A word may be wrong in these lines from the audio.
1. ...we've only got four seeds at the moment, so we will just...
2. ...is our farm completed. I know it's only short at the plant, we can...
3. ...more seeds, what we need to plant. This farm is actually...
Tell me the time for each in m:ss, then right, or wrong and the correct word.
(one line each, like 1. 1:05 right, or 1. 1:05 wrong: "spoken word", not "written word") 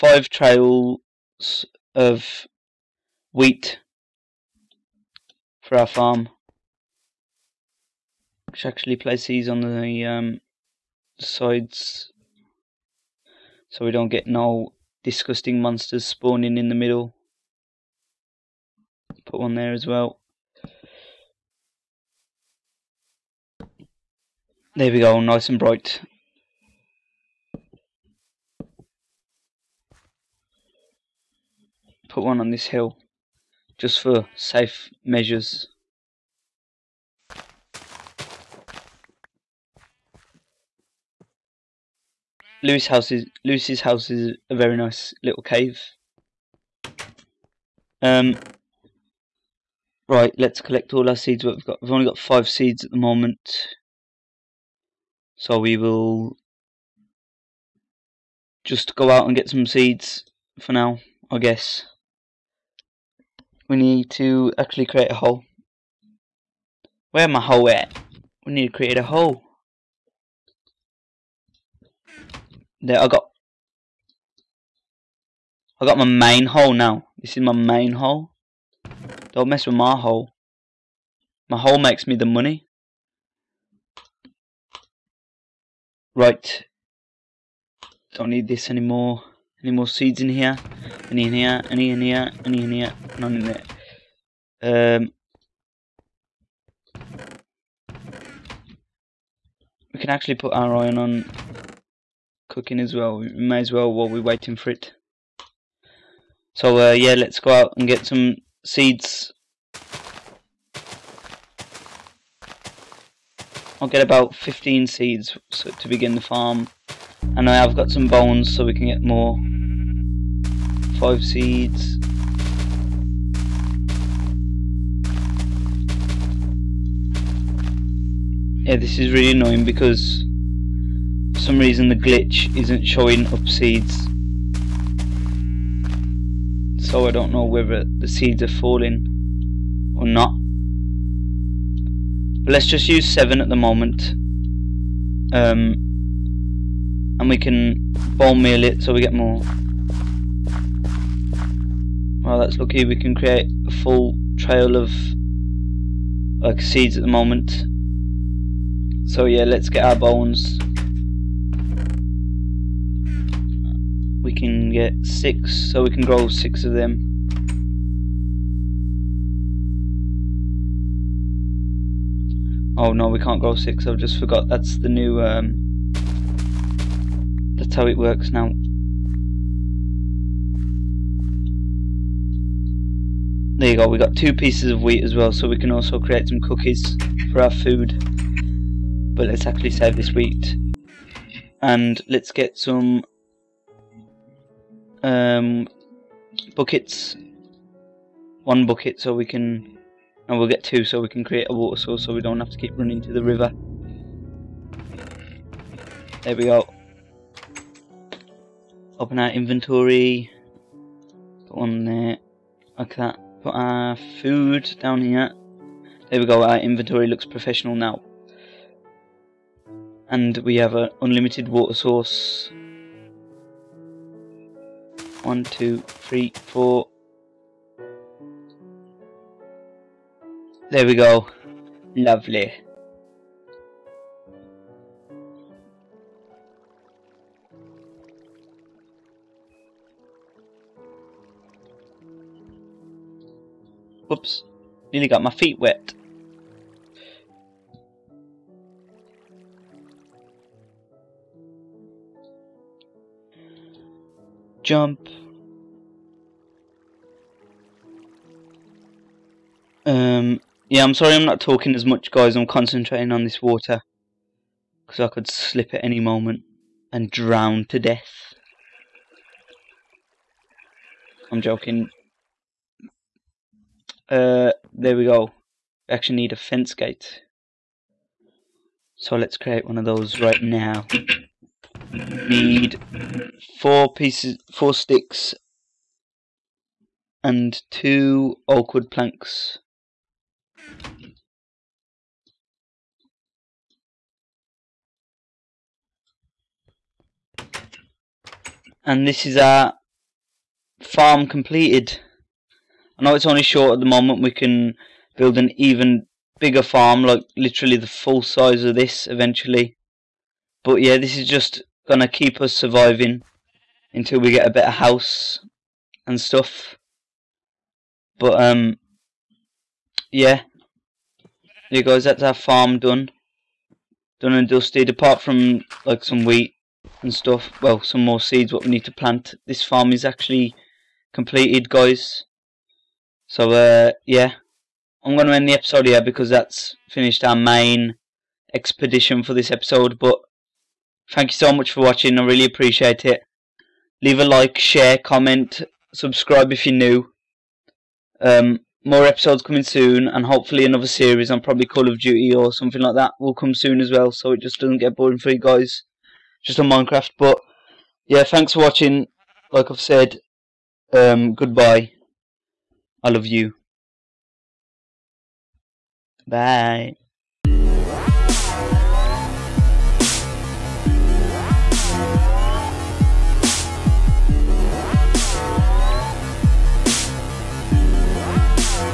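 1. 0:51 wrong: "five", not "four"
2. 4:59 wrong: "moment", not "plant"
3. 5:28 right.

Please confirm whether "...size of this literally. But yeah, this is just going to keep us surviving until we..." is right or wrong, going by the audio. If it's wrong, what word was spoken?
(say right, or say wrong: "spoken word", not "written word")
wrong: "eventually", not "literally".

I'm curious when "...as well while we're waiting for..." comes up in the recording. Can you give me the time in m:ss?
1:43.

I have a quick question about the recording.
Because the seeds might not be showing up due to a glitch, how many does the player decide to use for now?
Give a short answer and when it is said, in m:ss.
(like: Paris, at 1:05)
7, at 2:23.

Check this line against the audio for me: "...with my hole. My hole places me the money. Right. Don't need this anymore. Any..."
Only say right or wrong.
wrong.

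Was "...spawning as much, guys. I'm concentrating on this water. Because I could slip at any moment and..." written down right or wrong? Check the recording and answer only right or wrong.
wrong.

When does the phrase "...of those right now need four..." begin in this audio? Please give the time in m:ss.
4:39.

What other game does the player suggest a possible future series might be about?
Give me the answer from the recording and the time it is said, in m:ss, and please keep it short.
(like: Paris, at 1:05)
Call of Duty, at 5:51.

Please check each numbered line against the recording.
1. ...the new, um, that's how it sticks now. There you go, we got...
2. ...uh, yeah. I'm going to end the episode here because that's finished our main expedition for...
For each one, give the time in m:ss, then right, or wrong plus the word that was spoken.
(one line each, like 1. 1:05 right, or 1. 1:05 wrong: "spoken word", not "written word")
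1. 2:54 wrong: "works", not "sticks"
2. 5:33 right.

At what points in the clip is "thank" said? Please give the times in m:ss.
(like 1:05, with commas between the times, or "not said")
5:41, 5:58.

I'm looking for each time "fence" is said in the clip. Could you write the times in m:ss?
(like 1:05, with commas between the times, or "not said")
4:36.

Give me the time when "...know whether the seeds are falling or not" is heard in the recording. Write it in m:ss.
2:17.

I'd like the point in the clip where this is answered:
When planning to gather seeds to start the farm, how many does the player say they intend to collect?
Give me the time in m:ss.
1:54.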